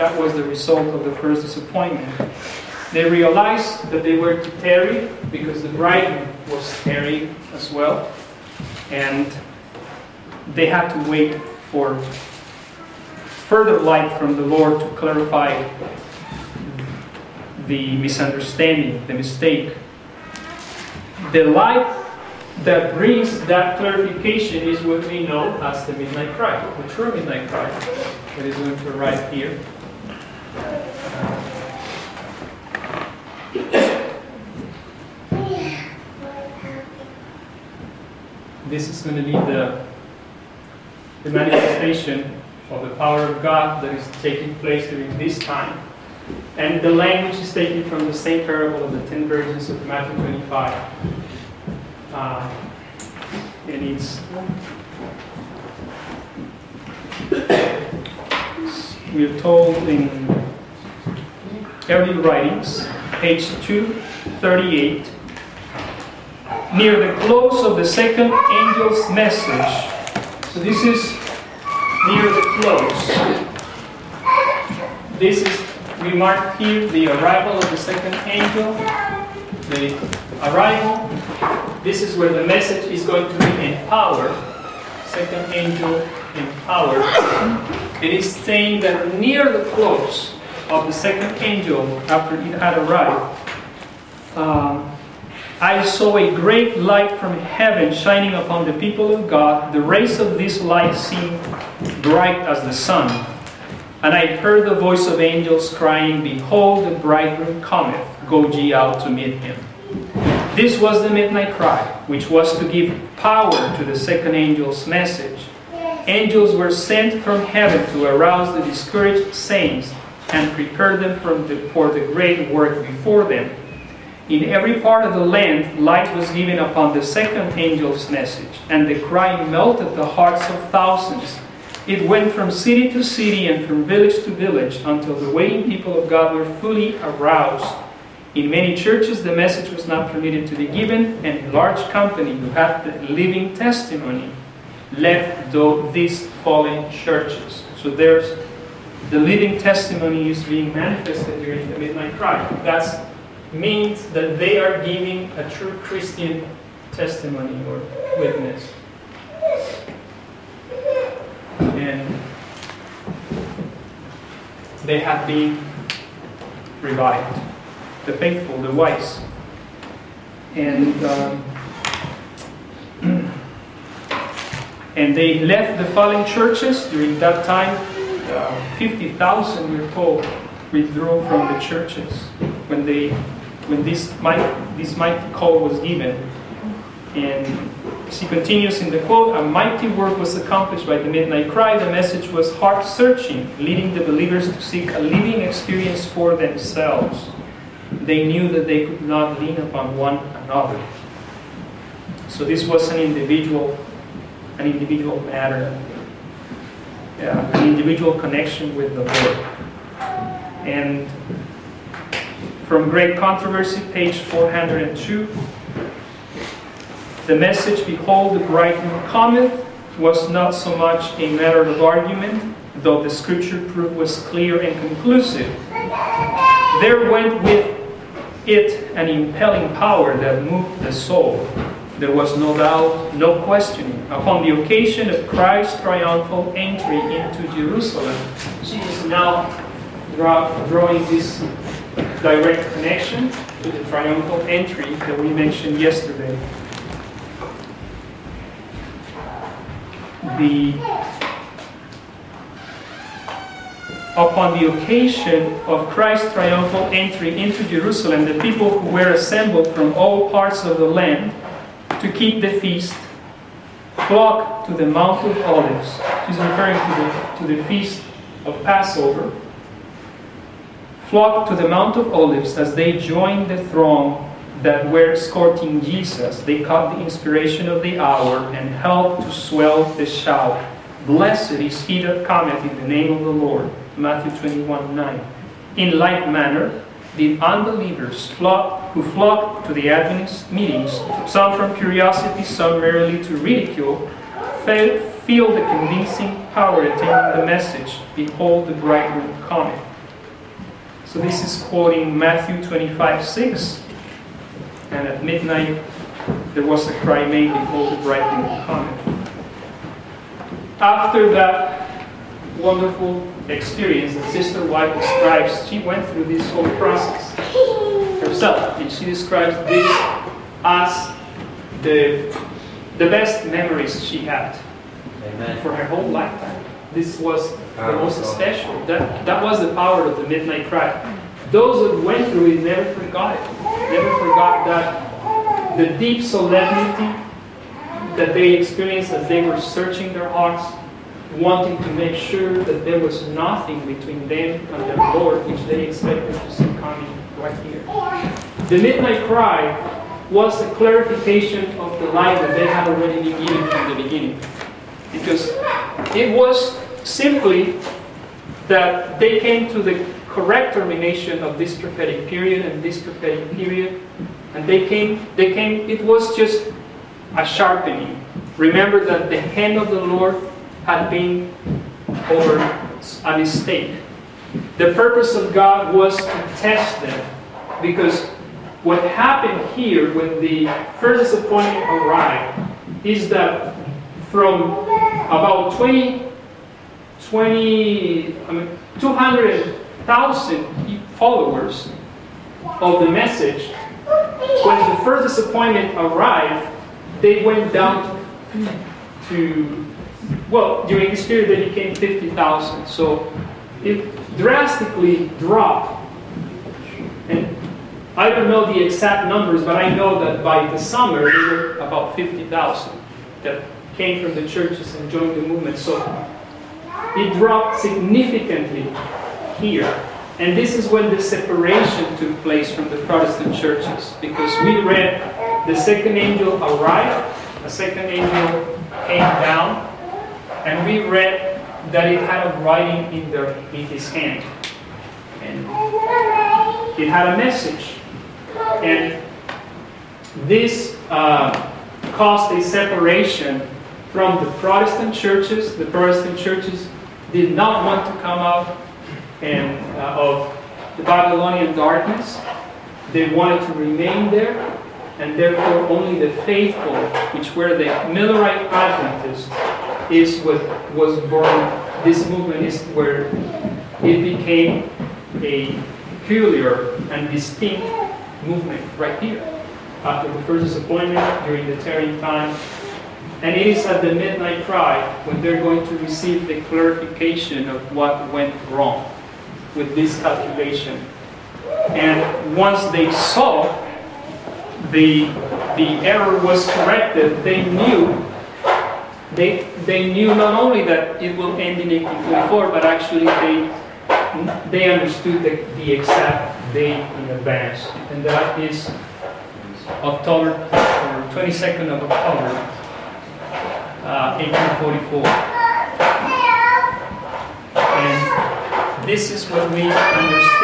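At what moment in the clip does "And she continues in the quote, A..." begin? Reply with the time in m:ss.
3:07.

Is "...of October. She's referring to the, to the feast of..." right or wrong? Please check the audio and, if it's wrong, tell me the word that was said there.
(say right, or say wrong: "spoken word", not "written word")
wrong: "Olives", not "October".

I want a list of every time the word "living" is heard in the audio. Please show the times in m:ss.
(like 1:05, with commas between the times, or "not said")
2:23, 2:29, 3:14.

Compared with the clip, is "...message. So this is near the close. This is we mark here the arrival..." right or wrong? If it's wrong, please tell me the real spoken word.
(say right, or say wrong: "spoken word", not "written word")
right.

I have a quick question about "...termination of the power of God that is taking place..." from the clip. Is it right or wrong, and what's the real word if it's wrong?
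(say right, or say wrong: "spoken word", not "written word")
wrong: "manifestation", not "termination".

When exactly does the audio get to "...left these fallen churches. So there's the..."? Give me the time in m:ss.
2:24.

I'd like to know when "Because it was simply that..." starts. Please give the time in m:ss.
5:55.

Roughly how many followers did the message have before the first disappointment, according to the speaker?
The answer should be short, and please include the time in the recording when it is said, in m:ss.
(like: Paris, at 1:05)
200,000, at 6:28.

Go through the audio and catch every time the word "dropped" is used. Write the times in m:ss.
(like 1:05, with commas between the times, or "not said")
6:45, 6:57.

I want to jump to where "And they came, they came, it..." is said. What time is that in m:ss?
6:04.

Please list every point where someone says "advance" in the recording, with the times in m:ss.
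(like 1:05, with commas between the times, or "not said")
8:17.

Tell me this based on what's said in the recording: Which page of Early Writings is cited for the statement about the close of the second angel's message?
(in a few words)
238.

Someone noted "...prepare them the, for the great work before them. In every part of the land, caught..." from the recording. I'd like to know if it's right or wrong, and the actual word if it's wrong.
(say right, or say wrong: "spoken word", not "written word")
wrong: "light", not "caught".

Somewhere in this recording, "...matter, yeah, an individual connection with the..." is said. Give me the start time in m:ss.
3:25.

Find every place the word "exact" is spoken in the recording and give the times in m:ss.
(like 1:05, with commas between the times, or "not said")
6:48, 8:15.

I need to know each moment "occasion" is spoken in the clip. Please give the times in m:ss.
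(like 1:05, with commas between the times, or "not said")
3:54, 4:14.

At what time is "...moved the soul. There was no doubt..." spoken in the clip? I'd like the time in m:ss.
3:50.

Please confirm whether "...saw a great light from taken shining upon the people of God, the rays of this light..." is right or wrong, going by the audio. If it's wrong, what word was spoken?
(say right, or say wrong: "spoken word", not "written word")
wrong: "heaven", not "taken".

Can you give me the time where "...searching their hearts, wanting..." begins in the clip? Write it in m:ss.
5:39.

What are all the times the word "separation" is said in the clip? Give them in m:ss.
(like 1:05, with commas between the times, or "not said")
7:01, 7:22.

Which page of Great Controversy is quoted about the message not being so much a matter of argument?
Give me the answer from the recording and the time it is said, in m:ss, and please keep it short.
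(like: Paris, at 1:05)
402, at 3:33.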